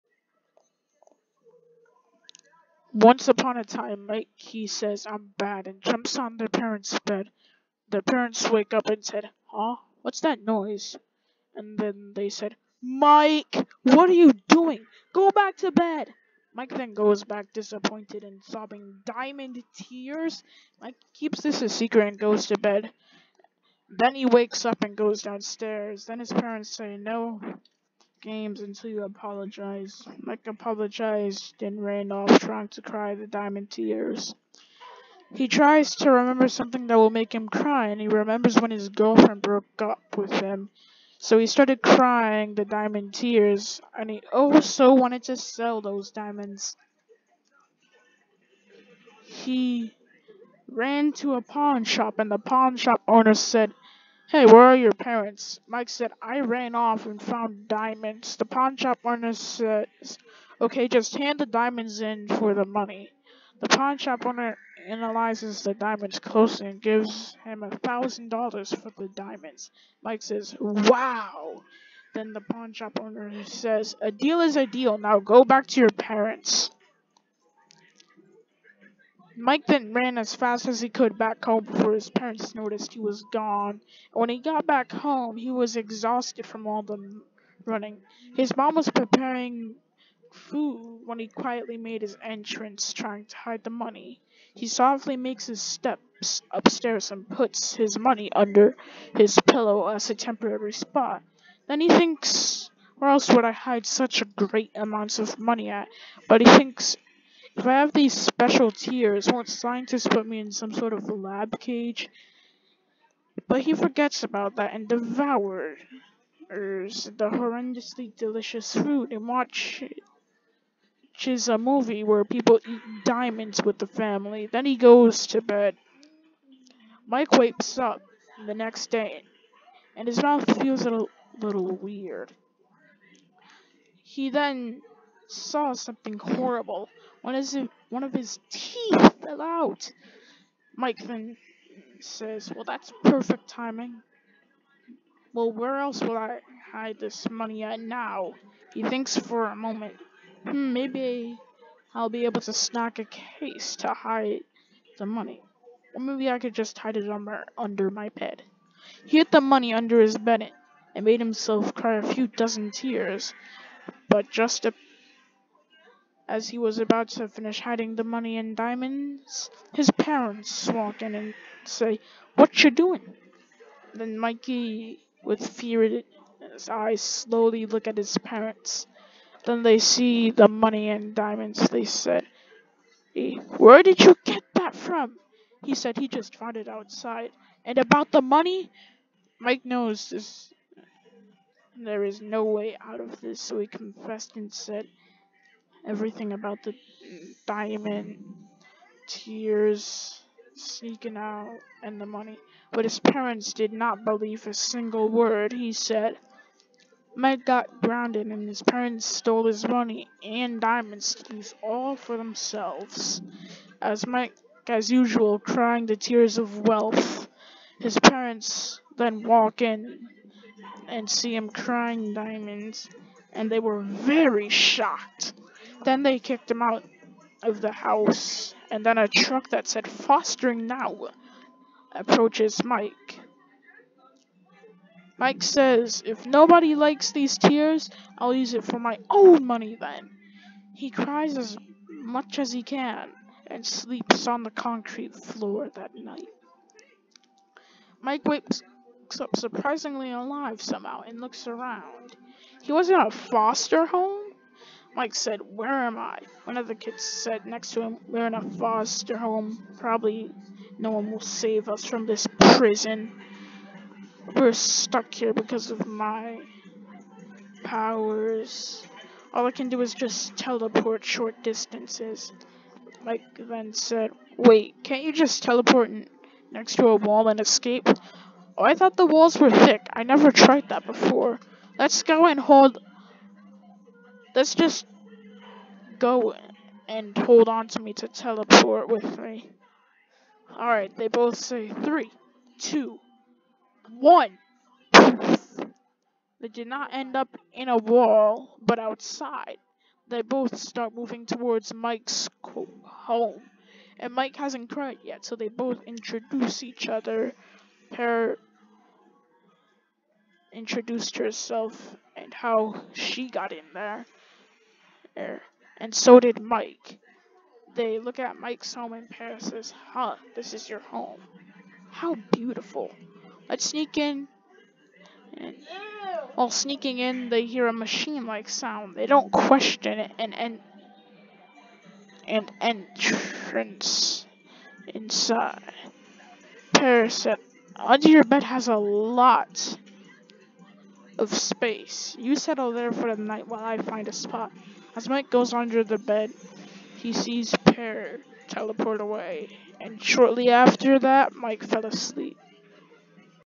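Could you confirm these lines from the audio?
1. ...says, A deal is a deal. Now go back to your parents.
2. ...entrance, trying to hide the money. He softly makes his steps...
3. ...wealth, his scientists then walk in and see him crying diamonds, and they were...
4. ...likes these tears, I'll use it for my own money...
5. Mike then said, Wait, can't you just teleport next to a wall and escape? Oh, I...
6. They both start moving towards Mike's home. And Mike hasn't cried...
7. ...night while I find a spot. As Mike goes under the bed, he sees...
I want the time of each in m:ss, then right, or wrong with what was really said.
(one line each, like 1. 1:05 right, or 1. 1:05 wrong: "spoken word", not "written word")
1. 1:13 right
2. 1:32 right
3. 3:36 wrong: "parents", not "scientists"
4. 3:56 right
5. 4:33 right
6. 5:00 right
7. 5:43 right.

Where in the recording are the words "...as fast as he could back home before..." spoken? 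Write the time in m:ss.
1:20.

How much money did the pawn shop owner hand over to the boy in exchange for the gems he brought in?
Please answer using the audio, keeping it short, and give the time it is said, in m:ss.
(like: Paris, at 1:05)
$1,000, at 1:07.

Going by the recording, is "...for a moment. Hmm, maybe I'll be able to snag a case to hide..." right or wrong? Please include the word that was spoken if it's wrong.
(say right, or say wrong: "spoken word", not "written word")
right.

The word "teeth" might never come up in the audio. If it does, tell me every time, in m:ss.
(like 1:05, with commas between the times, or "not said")
2:18.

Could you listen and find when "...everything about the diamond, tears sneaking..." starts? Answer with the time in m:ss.
3:15.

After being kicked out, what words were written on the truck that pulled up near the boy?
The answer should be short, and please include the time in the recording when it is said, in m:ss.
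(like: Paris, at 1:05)
fostering now, at 3:49.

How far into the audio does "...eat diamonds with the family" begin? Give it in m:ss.
2:02.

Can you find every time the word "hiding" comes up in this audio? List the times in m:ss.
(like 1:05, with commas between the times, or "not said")
2:47.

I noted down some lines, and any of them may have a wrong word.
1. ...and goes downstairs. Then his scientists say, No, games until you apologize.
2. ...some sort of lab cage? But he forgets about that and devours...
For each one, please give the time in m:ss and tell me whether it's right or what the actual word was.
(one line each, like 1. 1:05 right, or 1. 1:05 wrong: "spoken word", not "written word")
1. 0:24 wrong: "parents", not "scientists"
2. 1:50 right.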